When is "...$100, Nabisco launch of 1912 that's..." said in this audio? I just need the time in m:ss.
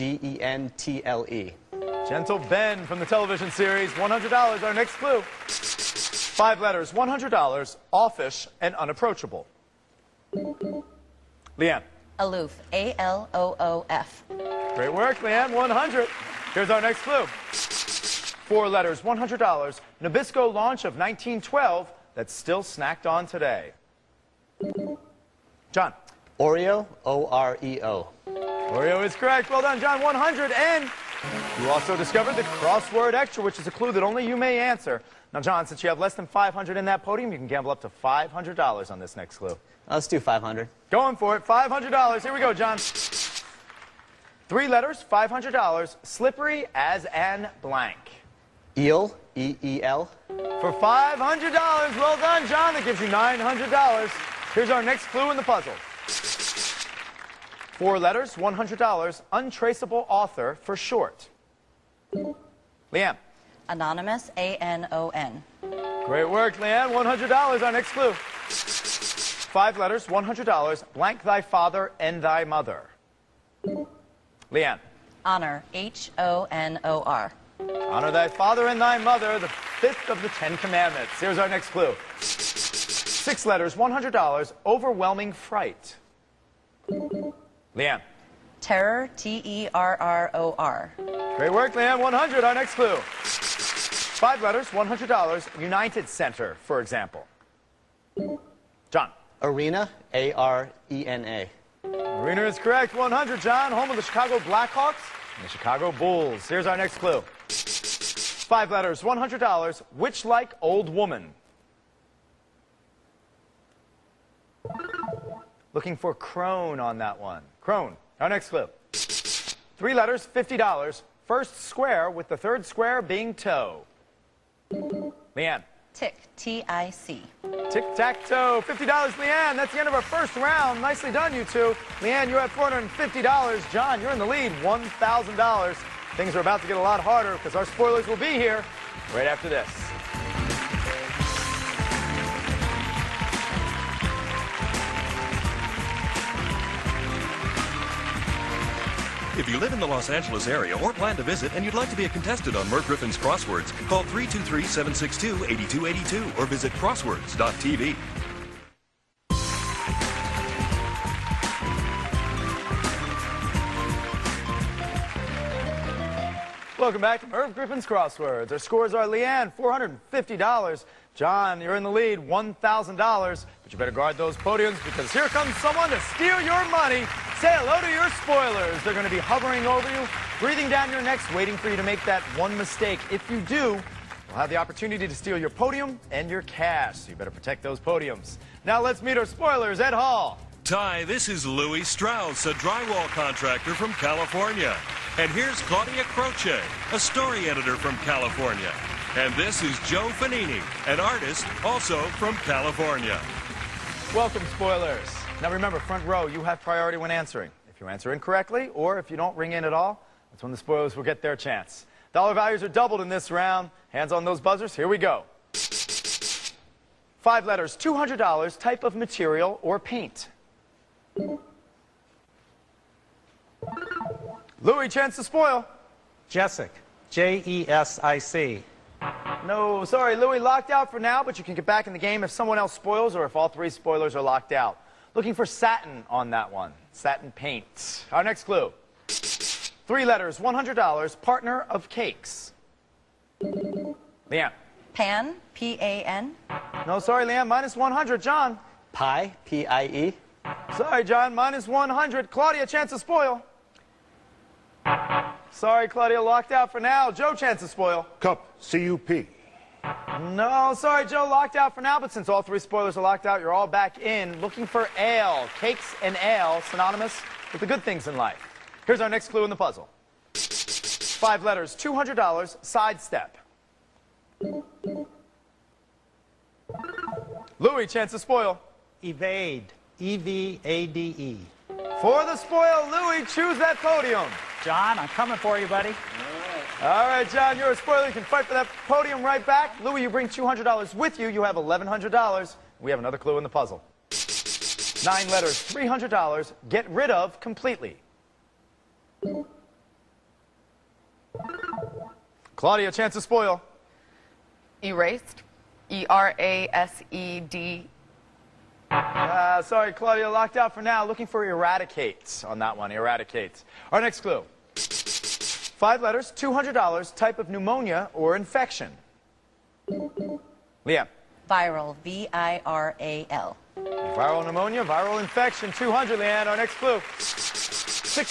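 0:19.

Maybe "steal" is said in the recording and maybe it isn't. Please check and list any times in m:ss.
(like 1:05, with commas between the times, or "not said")
2:56, 3:05.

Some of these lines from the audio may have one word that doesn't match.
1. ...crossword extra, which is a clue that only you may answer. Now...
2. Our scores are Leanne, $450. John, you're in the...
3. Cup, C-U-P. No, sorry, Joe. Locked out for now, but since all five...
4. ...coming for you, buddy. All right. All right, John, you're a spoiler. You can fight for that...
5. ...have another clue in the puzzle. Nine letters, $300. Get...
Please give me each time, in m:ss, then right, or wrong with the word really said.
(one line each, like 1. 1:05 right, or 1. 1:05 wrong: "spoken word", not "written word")
1. 0:32 right
2. 2:48 right
3. 4:18 wrong: "three", not "five"
4. 4:45 right
5. 4:52 right.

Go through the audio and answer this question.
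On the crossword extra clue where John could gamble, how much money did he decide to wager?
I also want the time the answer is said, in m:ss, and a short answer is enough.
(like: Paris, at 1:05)
$500, at 0:39.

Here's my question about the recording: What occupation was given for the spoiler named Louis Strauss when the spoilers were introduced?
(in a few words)
drywall contractor.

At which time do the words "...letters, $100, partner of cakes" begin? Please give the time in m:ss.
4:00.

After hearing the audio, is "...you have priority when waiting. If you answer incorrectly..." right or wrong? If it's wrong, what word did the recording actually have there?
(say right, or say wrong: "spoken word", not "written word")
wrong: "answering", not "waiting".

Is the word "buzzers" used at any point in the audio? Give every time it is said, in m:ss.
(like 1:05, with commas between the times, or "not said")
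3:34.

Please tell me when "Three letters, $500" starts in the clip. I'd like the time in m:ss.
0:44.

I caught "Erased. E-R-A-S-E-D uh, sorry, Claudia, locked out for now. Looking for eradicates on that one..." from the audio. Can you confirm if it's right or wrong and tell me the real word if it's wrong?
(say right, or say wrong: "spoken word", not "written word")
right.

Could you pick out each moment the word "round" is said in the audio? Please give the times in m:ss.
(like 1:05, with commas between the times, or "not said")
2:10, 3:33.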